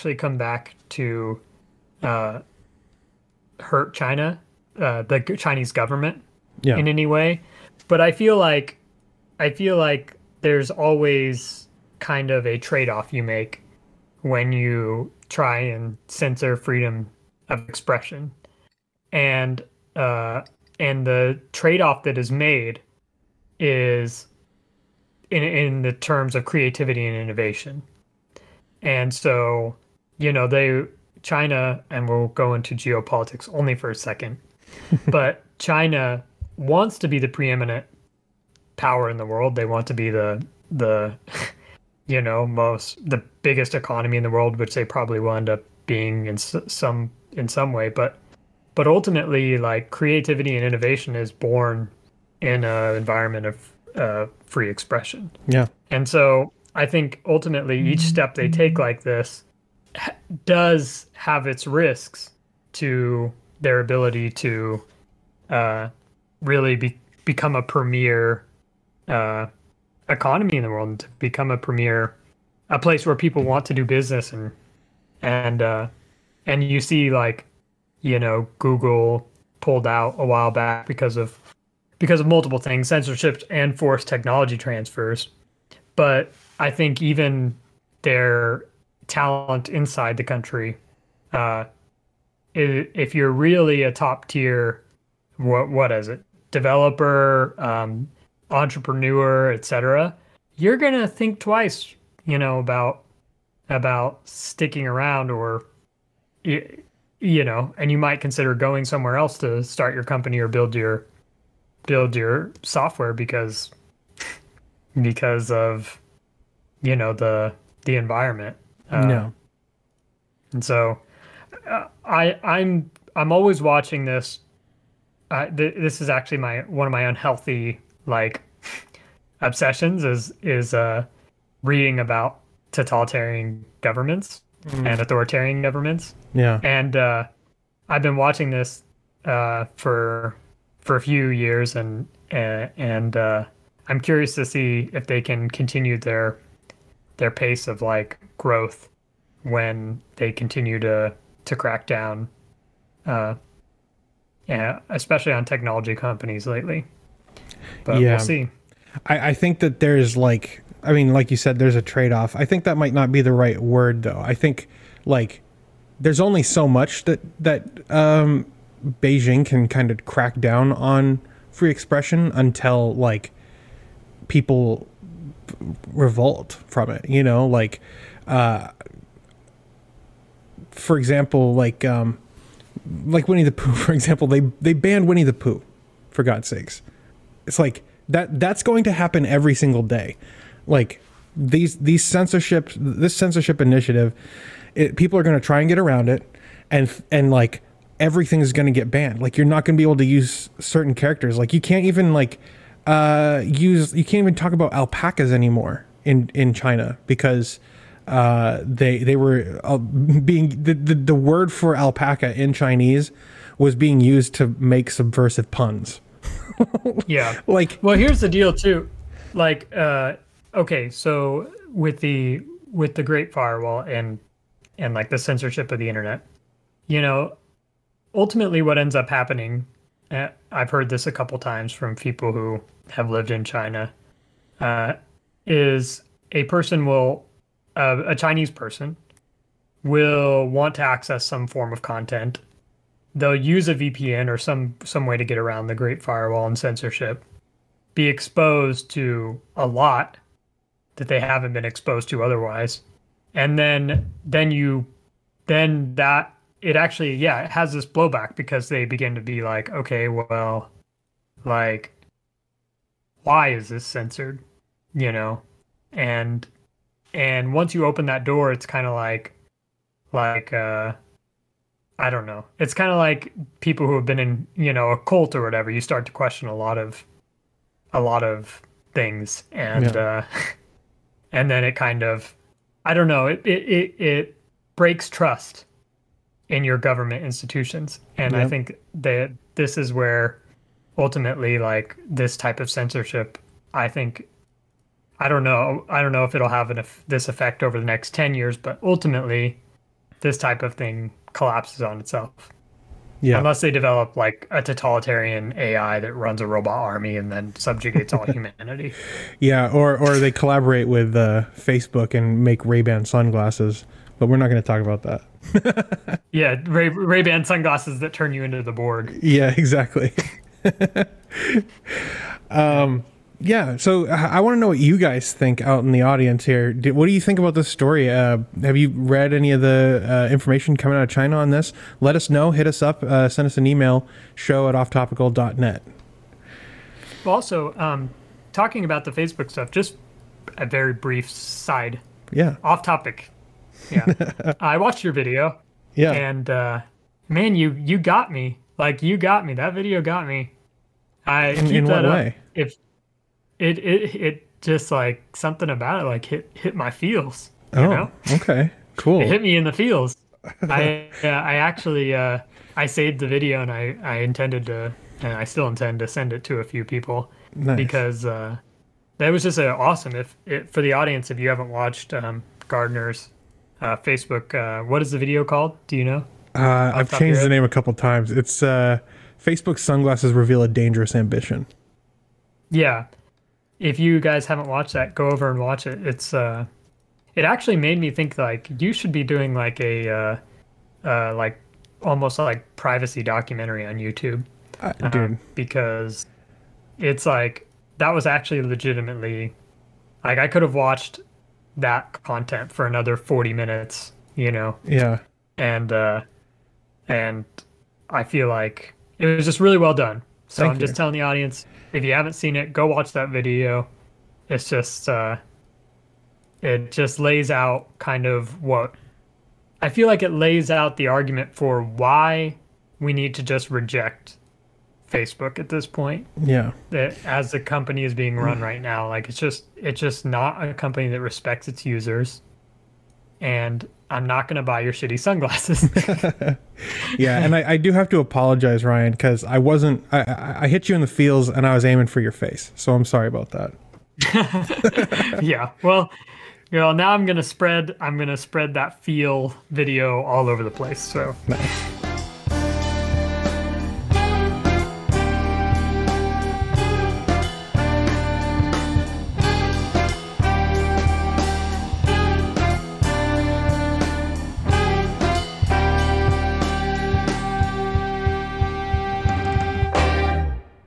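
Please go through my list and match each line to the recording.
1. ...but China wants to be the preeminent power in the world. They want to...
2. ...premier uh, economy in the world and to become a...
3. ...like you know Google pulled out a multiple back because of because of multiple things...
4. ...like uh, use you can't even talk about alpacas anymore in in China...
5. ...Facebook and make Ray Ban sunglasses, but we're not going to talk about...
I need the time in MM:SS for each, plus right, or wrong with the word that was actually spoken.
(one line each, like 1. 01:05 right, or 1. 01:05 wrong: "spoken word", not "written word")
1. 00:35 right
2. 01:07 right
3. 01:17 wrong: "while", not "multiple"
4. 03:22 right
5. 05:11 right.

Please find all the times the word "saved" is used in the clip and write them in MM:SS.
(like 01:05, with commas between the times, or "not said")
06:02.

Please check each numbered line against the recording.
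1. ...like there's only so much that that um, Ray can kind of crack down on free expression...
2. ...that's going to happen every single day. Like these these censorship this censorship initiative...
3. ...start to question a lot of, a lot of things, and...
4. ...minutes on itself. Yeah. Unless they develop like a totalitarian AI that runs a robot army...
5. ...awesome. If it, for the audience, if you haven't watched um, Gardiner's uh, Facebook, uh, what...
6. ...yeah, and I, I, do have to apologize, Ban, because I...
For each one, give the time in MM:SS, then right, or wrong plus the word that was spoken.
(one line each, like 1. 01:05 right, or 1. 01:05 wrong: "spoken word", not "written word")
1. 02:45 wrong: "Beijing", not "Ray"
2. 03:08 right
3. 04:35 right
4. 05:01 wrong: "collapses", not "minutes"
5. 06:09 right
6. 07:17 wrong: "Ryan", not "Ban".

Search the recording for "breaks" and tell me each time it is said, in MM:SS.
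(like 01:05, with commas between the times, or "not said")
04:44.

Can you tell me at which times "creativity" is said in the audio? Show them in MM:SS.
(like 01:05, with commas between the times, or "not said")
00:26, 00:49.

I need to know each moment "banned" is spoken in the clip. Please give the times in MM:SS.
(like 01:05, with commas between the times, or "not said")
03:04, 03:18.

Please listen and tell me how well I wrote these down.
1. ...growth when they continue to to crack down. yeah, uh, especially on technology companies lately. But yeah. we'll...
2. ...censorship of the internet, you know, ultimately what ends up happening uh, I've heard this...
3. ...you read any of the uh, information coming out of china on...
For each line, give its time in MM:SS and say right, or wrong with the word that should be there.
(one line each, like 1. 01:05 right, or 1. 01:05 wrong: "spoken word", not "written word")
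1. 02:28 right
2. 03:45 right
3. 05:28 right.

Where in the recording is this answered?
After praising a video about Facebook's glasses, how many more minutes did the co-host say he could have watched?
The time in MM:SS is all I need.
06:43.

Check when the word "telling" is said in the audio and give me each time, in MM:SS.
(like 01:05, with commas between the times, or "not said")
06:50.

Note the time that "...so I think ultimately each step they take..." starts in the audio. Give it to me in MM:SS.
00:56.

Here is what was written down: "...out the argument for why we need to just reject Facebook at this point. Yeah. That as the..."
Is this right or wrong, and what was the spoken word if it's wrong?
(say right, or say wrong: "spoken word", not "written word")
right.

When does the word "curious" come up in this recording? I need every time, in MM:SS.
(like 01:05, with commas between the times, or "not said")
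02:24.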